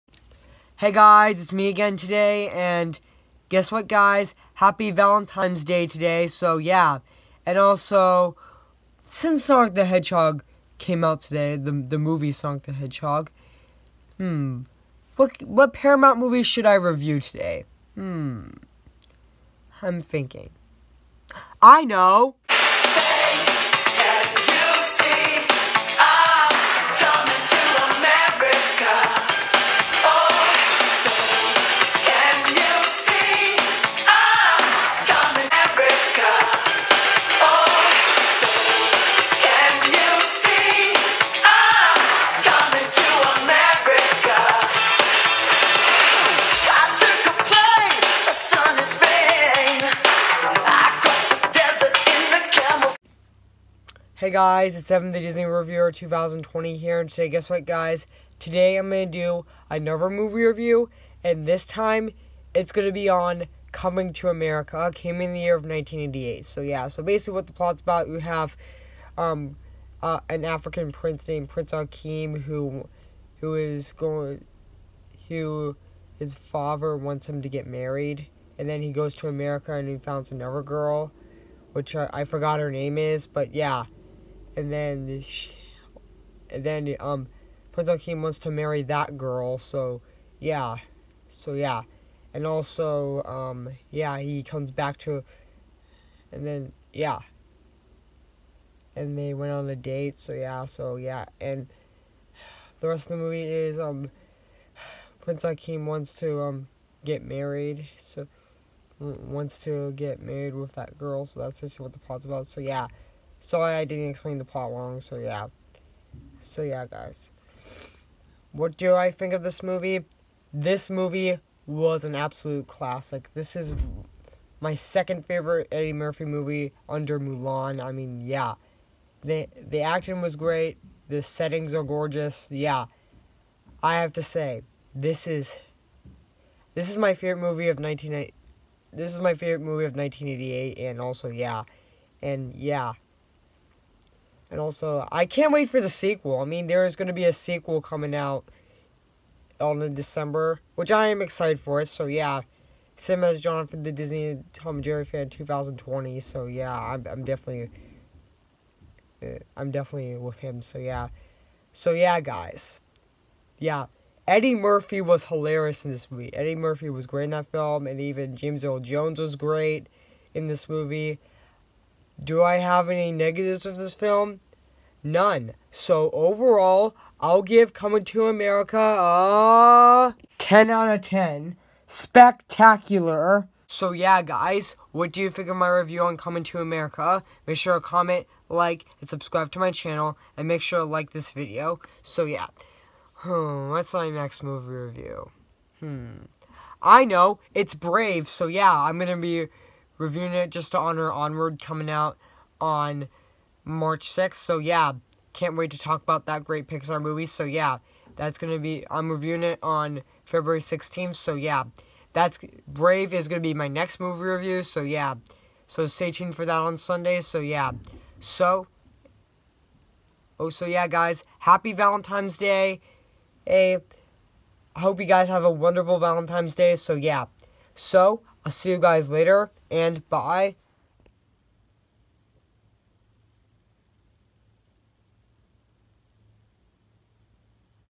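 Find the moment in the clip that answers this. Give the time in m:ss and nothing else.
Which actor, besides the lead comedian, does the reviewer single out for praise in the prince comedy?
2:48.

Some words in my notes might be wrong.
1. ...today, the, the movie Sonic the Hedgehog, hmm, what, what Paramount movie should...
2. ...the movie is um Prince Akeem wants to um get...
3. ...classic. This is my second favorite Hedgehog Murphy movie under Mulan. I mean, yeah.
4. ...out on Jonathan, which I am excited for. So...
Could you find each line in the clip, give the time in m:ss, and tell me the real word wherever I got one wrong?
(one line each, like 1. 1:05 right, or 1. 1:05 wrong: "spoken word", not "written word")
1. 0:11 right
2. 1:43 right
3. 2:02 wrong: "Eddie", not "Hedgehog"
4. 2:28 wrong: "December", not "Jonathan".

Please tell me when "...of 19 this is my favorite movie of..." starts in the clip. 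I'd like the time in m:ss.
2:17.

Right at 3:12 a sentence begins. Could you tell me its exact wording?
So yeah, hmm, what's my next movie review?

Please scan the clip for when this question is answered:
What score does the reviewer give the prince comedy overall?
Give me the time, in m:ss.
3:00.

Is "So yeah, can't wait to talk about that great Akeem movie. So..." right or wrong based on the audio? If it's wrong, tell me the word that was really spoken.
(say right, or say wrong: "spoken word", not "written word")
wrong: "Pixar", not "Akeem".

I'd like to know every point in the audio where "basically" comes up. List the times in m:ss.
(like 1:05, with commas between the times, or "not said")
1:07, 1:51.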